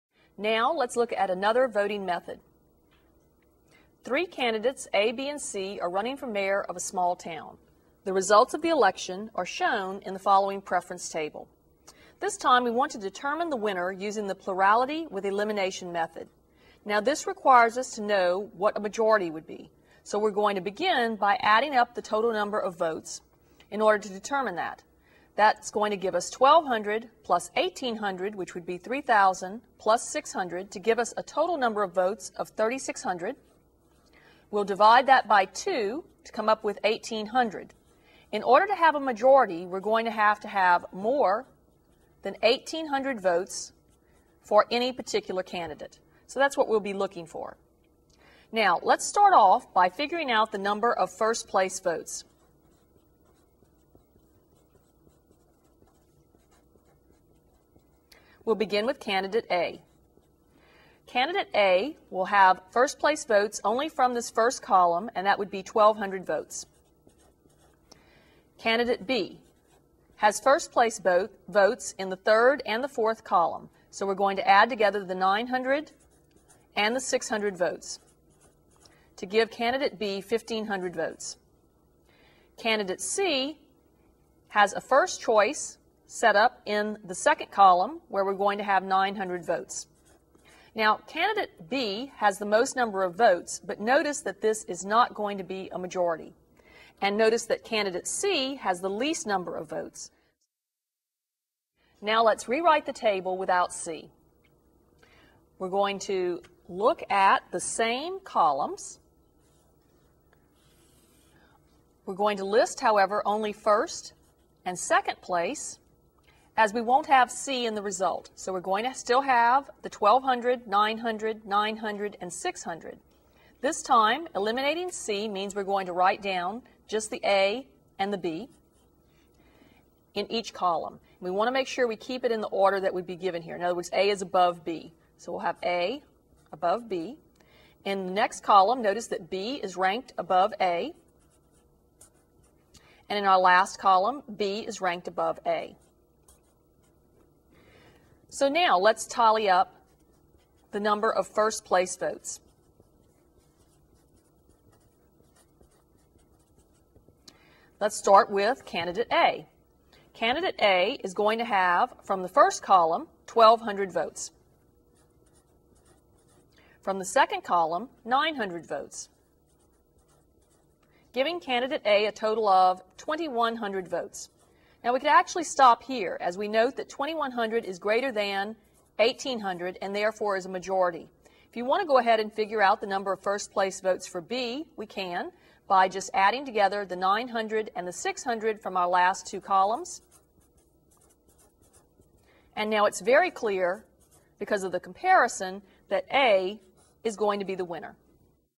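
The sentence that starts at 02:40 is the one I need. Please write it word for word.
Candidate A is going to have, from the first column, 1,200 votes.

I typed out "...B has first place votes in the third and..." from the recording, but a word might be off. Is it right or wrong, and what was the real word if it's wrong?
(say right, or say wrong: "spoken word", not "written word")
right.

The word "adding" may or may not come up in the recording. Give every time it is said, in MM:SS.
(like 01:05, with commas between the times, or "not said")
00:21, 03:06.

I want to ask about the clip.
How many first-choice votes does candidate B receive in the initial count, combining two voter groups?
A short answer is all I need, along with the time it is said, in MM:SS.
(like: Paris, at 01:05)
1,500, at 01:20.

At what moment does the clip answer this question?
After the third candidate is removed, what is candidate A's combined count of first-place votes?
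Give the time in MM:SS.
02:52.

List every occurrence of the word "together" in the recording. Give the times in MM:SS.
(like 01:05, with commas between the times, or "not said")
01:14, 03:06.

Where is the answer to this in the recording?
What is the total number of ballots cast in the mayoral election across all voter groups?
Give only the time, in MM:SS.
00:32.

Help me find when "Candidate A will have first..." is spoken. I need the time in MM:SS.
01:01.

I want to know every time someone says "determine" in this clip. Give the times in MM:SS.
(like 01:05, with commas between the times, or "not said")
00:12, 00:24.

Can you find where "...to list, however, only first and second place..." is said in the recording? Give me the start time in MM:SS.
01:52.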